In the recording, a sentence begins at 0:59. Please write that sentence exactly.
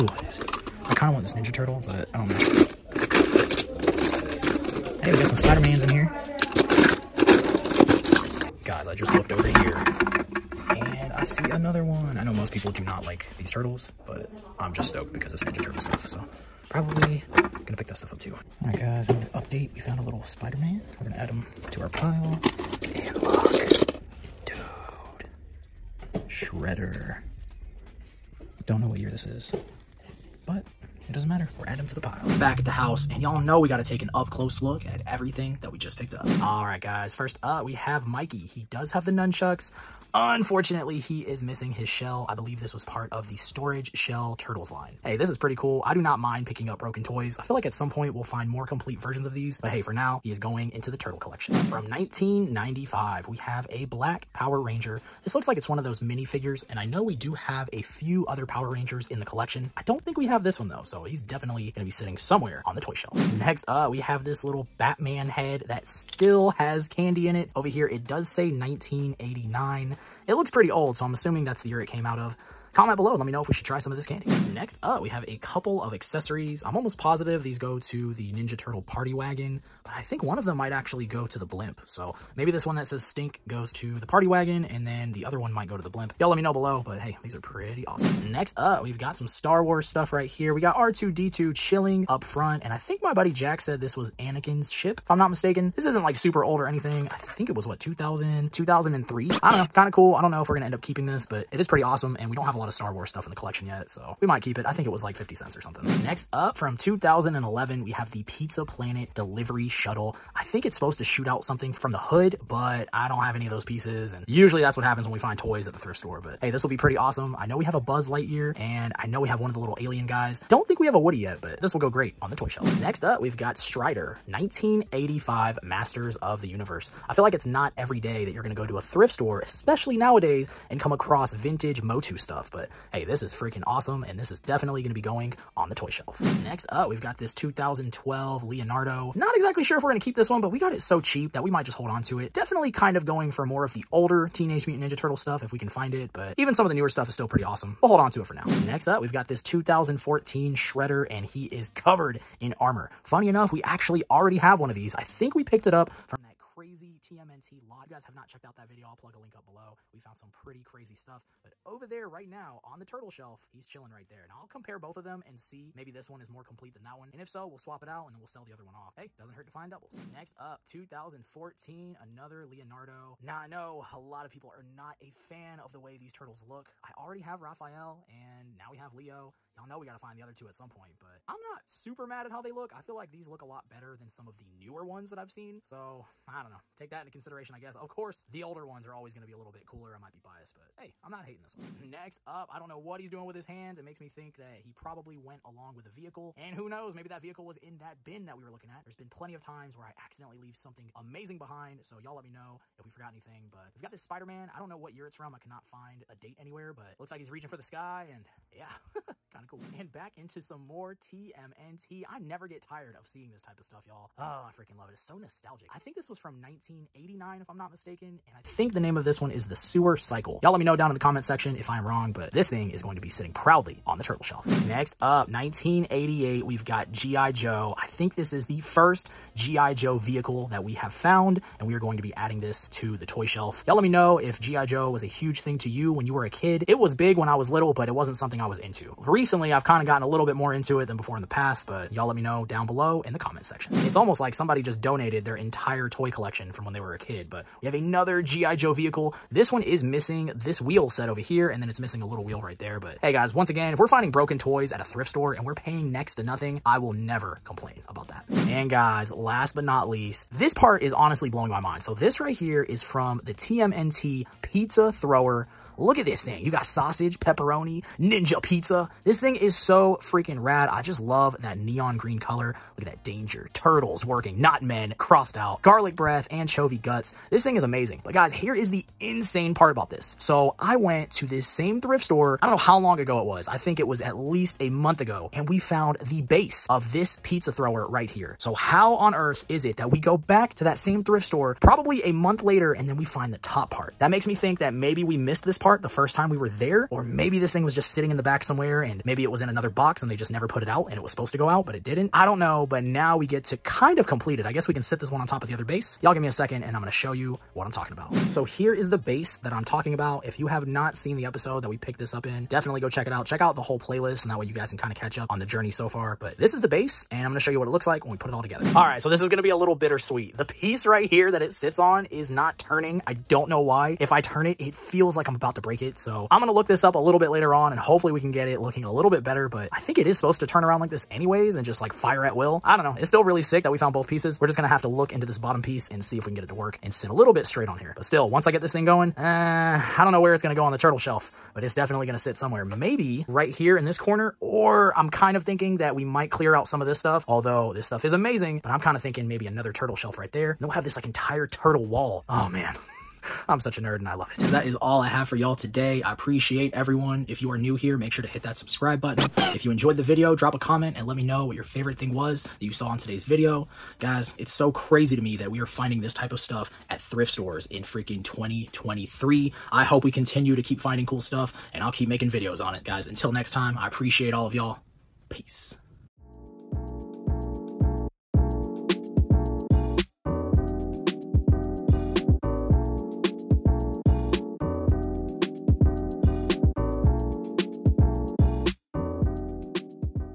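I don't think we have this one though, so he's definitely gonna be sitting somewhere on the toy shelf.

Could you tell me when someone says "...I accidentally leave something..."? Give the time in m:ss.
3:19.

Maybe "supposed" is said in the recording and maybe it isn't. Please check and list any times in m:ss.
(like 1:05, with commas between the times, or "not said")
1:50, 5:01, 5:30.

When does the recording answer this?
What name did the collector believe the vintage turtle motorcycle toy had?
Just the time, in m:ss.
3:39.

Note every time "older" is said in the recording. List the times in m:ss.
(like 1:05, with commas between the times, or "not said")
2:23, 3:08.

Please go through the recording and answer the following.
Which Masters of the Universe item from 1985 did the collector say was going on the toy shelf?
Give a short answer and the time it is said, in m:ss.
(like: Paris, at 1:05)
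Strider, at 2:03.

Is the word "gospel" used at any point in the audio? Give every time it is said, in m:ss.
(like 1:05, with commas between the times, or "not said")
not said.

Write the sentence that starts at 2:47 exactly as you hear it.
And if so, we'll swap it out and then we'll sell the other one off.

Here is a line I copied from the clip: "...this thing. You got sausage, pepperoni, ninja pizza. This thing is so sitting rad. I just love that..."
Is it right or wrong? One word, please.
wrong.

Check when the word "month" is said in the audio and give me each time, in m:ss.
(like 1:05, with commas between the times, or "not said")
4:44, 4:52.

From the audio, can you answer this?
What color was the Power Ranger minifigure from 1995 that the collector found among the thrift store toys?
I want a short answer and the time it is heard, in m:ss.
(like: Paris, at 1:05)
Black, at 0:53.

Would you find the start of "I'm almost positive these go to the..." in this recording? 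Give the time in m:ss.
1:16.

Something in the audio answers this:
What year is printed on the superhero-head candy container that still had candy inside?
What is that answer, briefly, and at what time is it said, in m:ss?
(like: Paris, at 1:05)
1989, at 1:07.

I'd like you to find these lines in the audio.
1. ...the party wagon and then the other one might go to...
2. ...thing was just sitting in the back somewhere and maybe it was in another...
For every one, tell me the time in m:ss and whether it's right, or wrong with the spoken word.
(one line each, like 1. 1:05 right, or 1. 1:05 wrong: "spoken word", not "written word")
1. 1:23 right
2. 4:57 right.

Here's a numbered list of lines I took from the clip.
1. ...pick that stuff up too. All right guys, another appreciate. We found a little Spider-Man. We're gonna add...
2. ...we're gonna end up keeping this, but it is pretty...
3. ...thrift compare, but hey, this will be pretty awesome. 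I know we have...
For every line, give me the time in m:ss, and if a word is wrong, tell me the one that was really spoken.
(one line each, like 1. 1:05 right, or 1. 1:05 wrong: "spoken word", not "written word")
1. 0:17 wrong: "update", not "appreciate"
2. 1:40 right
3. 1:55 wrong: "store", not "compare".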